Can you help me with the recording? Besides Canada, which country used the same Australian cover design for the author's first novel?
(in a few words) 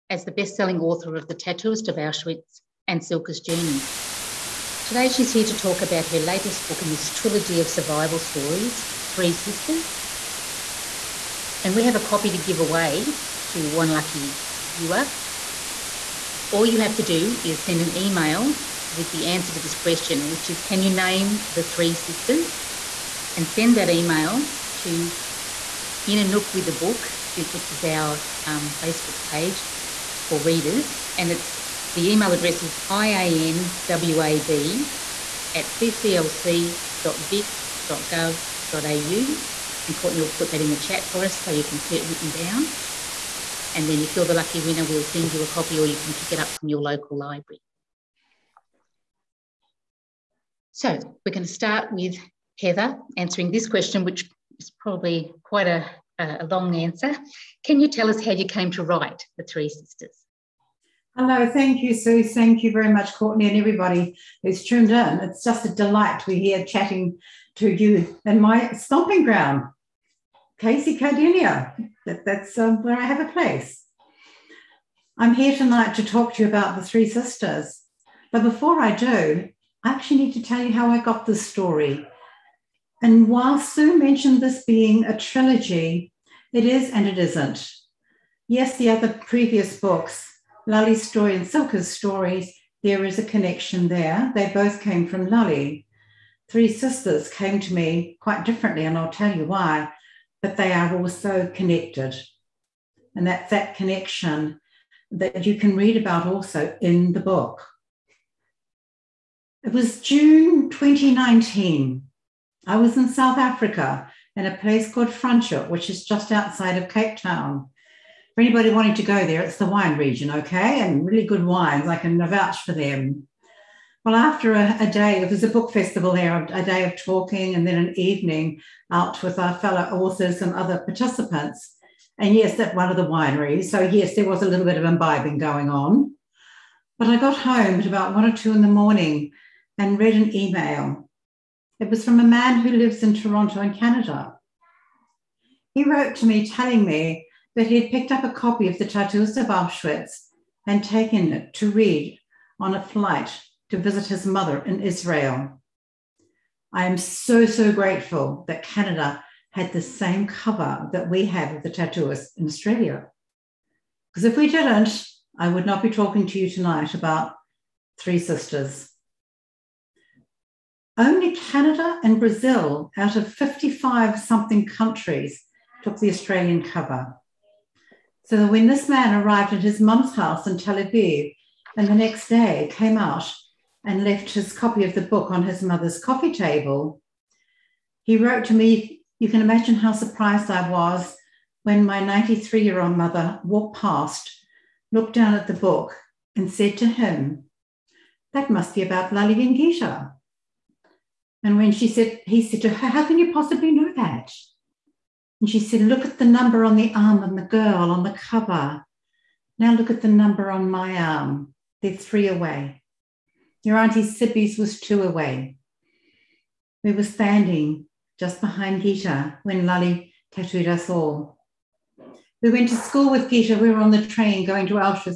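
Brazil.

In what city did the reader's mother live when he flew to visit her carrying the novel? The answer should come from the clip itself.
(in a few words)
Tel Aviv.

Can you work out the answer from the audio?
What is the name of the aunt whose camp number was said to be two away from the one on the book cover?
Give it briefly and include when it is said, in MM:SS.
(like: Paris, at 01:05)
Cibi, at 03:34.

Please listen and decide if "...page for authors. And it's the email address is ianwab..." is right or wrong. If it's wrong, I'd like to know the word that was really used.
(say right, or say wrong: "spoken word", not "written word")
wrong: "readers", not "authors".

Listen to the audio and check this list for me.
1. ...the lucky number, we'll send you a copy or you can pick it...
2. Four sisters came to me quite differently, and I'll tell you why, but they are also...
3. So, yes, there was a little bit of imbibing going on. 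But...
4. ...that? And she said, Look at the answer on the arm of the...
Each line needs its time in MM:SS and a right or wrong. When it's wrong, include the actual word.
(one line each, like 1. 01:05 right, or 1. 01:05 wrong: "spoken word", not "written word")
1. 00:44 wrong: "winner", not "number"
2. 01:36 wrong: "Three", not "Four"
3. 02:13 right
4. 03:23 wrong: "number", not "answer".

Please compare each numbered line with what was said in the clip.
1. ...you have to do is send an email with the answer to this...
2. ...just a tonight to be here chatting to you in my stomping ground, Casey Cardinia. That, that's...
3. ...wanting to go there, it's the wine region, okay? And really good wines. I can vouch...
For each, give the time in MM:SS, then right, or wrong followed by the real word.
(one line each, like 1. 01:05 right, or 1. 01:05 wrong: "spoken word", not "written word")
1. 00:16 right
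2. 01:05 wrong: "delight", not "tonight"
3. 01:58 right.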